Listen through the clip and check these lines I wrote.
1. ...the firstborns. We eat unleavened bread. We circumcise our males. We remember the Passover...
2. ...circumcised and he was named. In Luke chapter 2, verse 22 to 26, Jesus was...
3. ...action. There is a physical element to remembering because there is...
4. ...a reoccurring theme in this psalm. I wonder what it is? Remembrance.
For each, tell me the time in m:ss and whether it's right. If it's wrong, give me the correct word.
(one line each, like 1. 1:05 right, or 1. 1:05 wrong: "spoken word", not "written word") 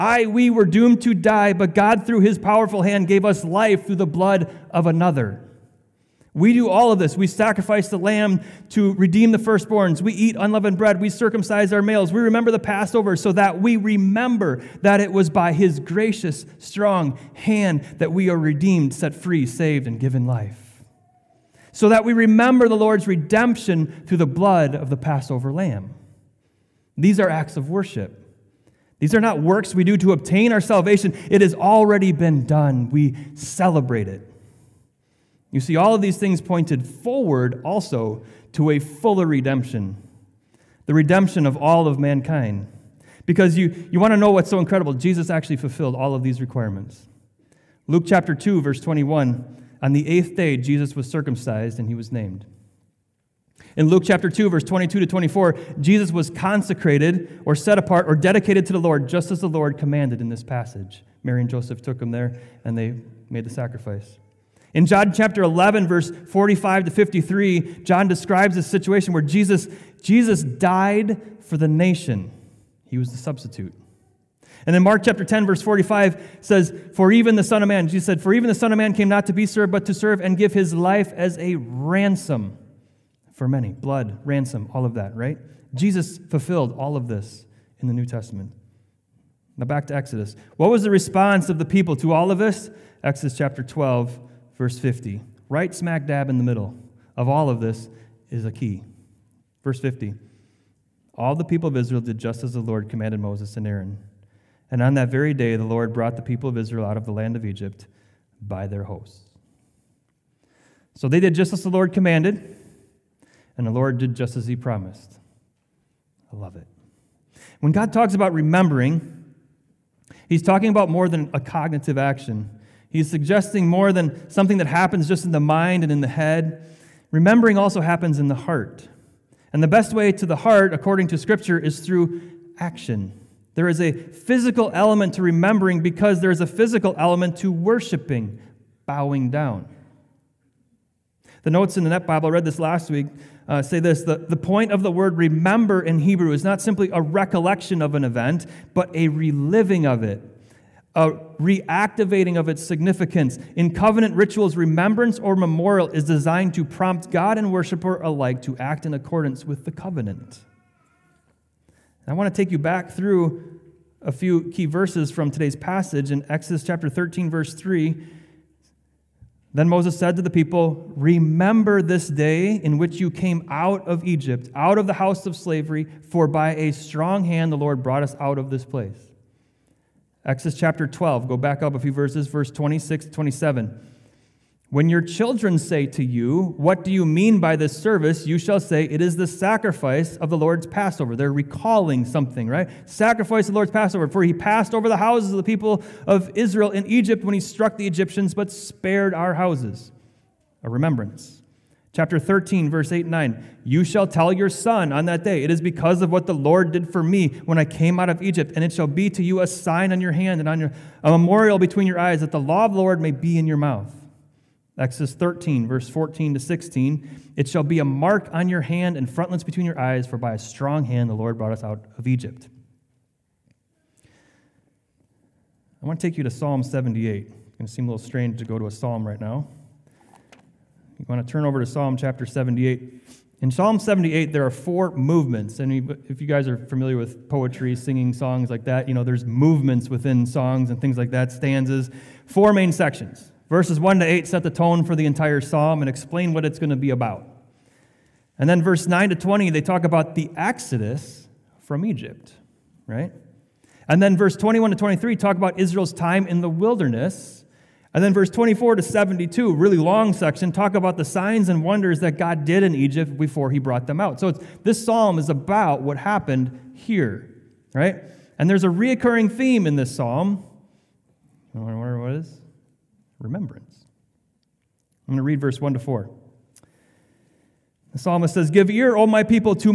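1. 0:09 right
2. 0:51 wrong: "24", not "26"
3. 2:12 right
4. 4:28 right.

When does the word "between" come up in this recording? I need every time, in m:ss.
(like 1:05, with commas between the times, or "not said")
3:31, 3:39.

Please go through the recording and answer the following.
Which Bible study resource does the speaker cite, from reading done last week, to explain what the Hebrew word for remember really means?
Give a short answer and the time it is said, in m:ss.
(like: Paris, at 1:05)
Net Bible, at 2:21.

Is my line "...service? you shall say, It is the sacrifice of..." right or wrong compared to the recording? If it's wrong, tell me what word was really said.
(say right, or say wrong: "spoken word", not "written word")
right.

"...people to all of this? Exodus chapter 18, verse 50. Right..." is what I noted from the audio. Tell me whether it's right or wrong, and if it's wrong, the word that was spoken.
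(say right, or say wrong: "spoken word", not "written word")
wrong: "12", not "18".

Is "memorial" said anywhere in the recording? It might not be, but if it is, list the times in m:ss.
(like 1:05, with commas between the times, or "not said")
2:35, 3:31.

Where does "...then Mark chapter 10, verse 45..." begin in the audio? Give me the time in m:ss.
1:14.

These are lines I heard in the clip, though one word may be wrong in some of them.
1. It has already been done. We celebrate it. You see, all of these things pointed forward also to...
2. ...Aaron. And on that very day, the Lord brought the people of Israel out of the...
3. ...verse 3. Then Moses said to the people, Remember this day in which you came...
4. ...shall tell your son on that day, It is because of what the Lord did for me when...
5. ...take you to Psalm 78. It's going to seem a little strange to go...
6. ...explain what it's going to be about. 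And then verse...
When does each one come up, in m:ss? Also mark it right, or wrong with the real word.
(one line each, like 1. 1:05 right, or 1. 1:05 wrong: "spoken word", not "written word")
1. 0:31 right
2. 1:43 right
3. 2:47 right
4. 3:23 right
5. 3:46 right
6. 4:05 right.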